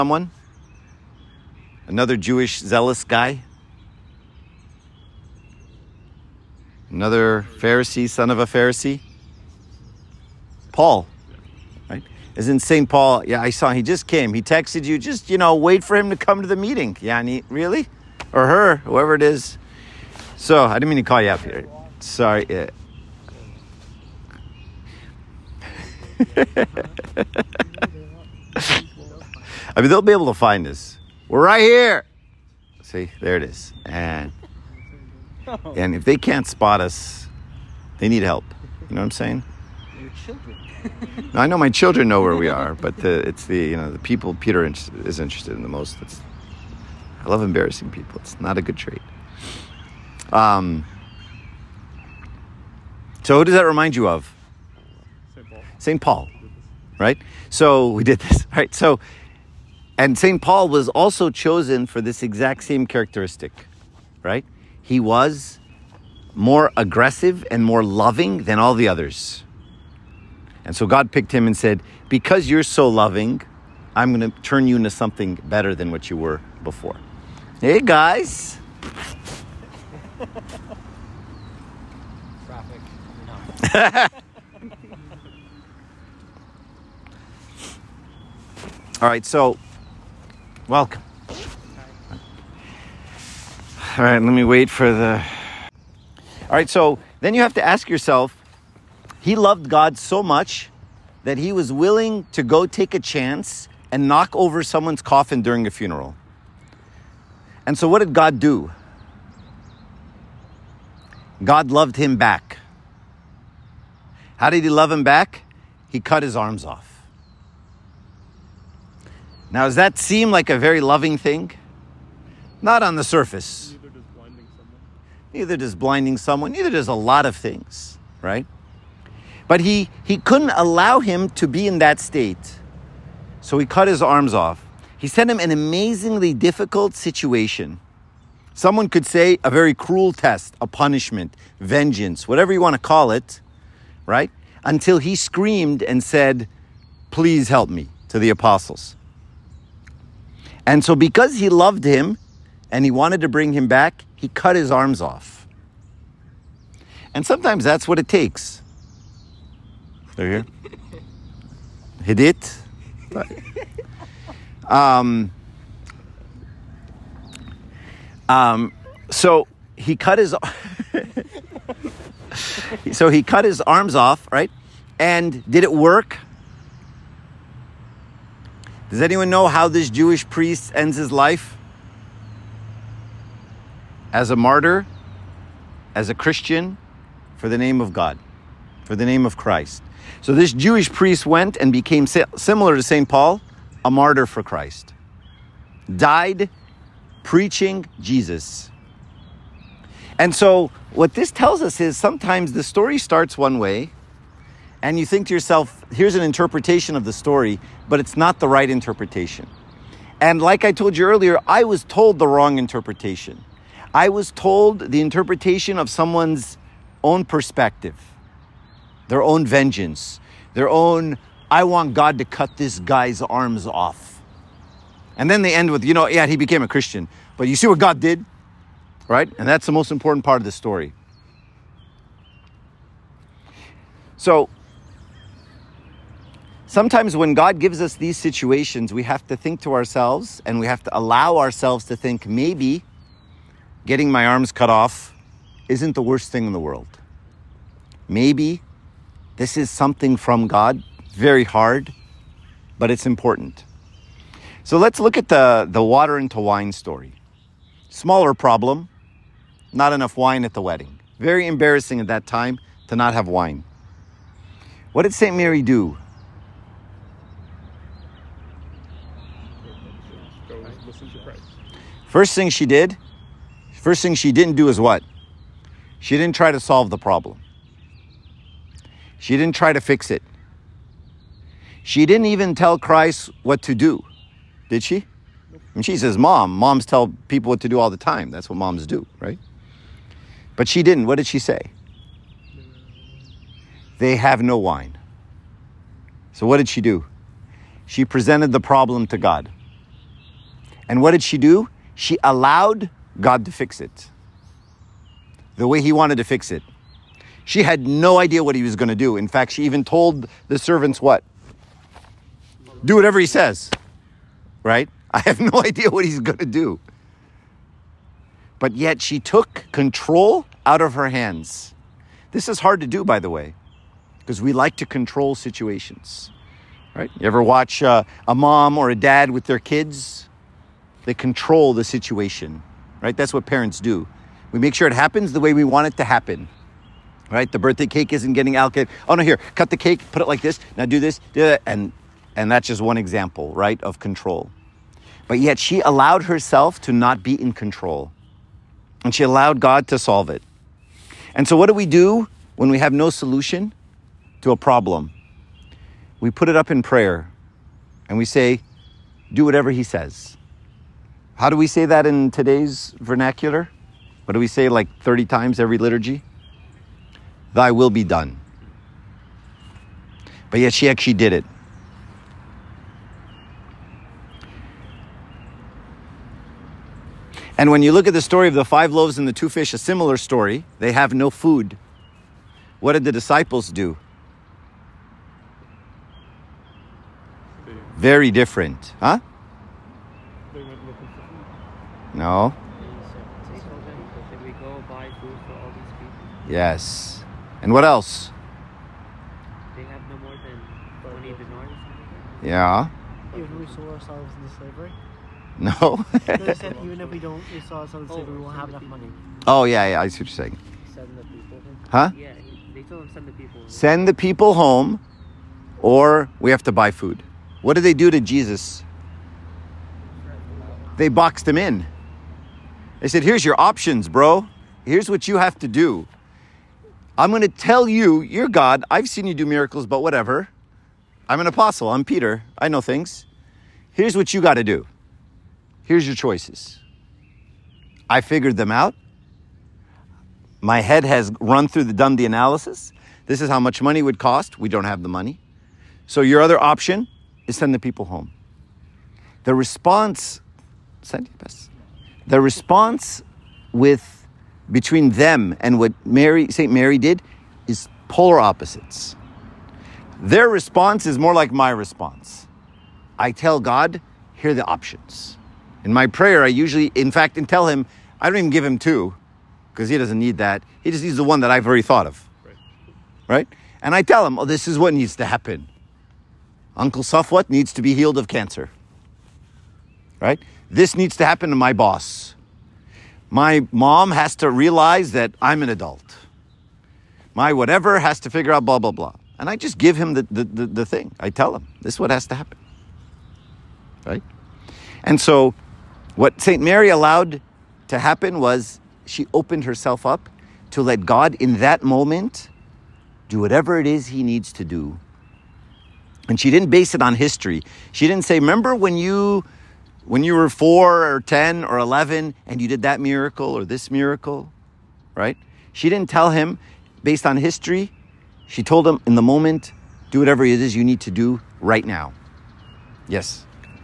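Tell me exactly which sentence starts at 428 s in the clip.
I've seen you do miracles, but whatever.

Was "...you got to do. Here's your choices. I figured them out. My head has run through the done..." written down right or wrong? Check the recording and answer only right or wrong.
right.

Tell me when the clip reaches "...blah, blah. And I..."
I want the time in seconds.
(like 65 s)
488 s.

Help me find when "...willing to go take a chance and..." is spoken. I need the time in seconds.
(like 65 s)
101 s.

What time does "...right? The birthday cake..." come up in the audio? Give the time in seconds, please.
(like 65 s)
337 s.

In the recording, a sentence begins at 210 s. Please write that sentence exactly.
And like I told you earlier, I was told the wrong interpretation.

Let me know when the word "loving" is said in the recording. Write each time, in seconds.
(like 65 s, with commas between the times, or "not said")
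67 s, 72 s, 120 s.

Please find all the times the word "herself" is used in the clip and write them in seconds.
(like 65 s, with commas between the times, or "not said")
346 s, 499 s.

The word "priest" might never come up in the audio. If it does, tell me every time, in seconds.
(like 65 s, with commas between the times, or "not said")
180 s, 190 s.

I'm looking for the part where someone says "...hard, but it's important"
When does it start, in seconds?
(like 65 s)
251 s.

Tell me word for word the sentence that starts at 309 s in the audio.
In fact, she even told the servants what?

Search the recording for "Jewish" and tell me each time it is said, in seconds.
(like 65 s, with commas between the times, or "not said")
2 s, 179 s, 190 s.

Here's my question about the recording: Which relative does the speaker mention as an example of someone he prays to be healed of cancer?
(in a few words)
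Uncle Safwat.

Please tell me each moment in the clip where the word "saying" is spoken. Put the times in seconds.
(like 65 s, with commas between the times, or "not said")
39 s, 410 s.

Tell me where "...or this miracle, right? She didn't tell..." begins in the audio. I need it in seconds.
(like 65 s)
513 s.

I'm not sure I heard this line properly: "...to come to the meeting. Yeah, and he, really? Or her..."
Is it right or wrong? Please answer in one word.
right.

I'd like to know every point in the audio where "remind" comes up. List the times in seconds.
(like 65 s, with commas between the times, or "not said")
53 s.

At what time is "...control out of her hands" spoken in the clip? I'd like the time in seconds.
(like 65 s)
319 s.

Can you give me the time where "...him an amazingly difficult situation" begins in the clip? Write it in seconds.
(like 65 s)
135 s.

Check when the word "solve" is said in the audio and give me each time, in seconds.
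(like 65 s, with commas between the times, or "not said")
276 s, 349 s.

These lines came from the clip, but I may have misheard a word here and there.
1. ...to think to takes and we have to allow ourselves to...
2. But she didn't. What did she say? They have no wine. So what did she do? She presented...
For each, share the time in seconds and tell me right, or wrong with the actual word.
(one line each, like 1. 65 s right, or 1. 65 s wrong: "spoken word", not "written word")
1. 239 s wrong: "ourselves", not "takes"
2. 290 s right.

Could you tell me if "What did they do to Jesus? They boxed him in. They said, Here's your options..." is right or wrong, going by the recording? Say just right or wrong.
right.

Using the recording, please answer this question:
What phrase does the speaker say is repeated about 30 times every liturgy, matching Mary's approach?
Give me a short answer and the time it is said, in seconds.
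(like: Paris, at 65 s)
Thy will be done, at 367 s.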